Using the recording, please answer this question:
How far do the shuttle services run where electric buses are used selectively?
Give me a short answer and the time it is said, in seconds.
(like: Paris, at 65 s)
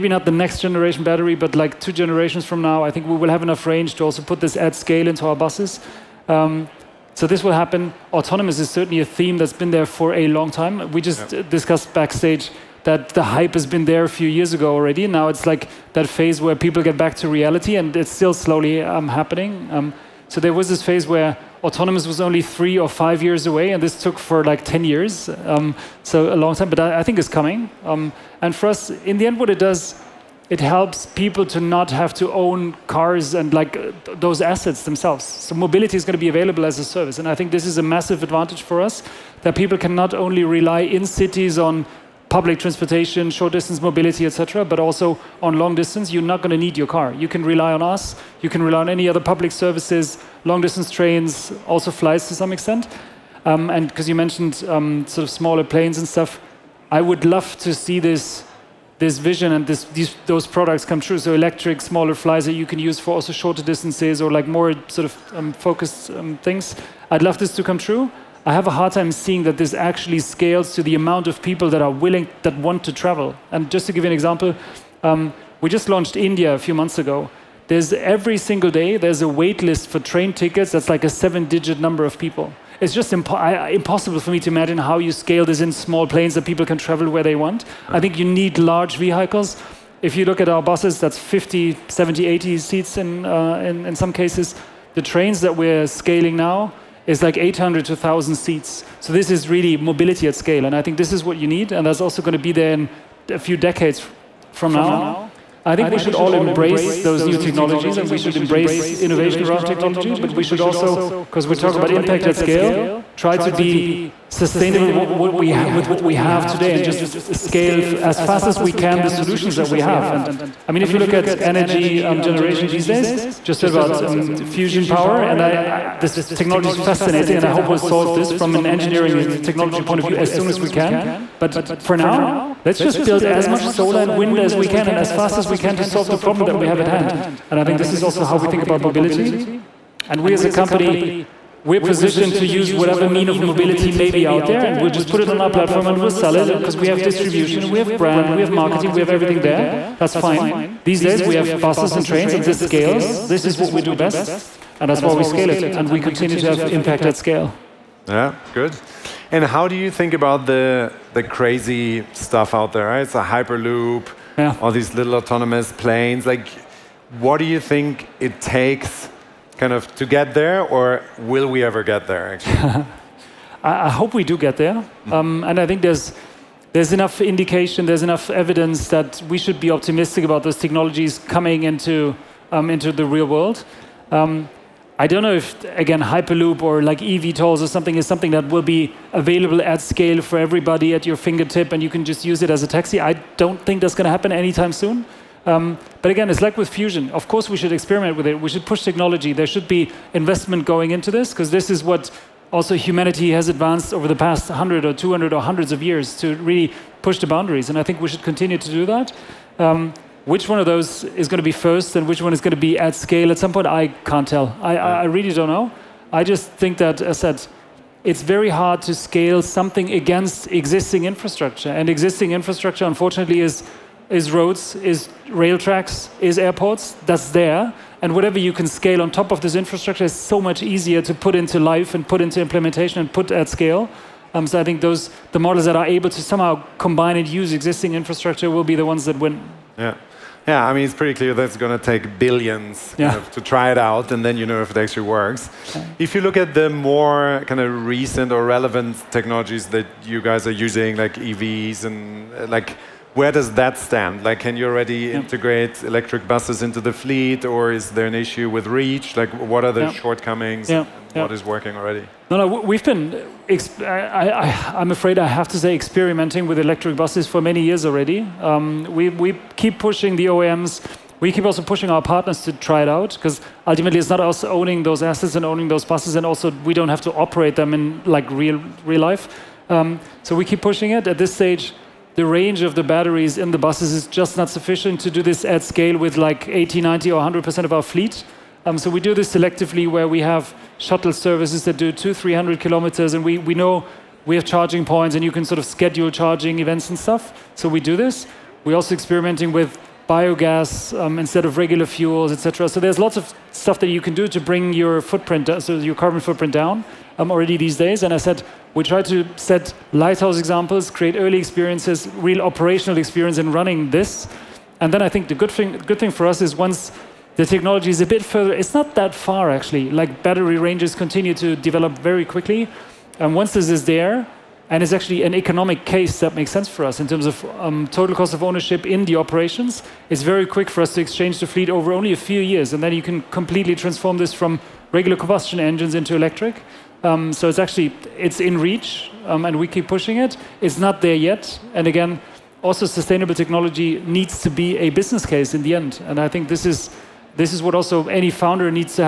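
200 to 300 kilometers, at 291 s.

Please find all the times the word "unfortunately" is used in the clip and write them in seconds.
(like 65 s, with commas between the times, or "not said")
222 s.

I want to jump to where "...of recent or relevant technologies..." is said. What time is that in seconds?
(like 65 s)
247 s.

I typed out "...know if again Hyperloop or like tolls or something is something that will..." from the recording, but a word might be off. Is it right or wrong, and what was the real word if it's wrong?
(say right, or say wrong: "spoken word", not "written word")
right.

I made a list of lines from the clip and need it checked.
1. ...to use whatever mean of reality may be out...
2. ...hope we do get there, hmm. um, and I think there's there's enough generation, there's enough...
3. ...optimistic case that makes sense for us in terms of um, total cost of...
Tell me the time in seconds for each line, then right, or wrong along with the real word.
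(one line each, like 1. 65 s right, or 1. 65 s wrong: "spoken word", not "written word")
1. 142 s wrong: "mobility", not "reality"
2. 173 s wrong: "indication", not "generation"
3. 325 s wrong: "economic", not "optimistic".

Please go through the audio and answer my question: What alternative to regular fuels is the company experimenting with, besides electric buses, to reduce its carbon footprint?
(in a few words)
Biogas.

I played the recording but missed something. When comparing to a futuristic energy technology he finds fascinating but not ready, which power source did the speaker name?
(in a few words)
Fusion power.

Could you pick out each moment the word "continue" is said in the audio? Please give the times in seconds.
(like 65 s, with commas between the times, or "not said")
156 s, 208 s, 320 s.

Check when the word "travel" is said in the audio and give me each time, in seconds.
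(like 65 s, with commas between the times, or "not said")
72 s, 86 s.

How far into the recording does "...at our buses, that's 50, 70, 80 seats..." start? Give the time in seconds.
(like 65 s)
90 s.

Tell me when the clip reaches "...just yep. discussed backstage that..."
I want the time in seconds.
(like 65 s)
11 s.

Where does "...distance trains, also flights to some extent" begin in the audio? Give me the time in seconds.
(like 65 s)
50 s.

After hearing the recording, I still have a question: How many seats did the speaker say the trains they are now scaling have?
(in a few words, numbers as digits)
800 to 1,000.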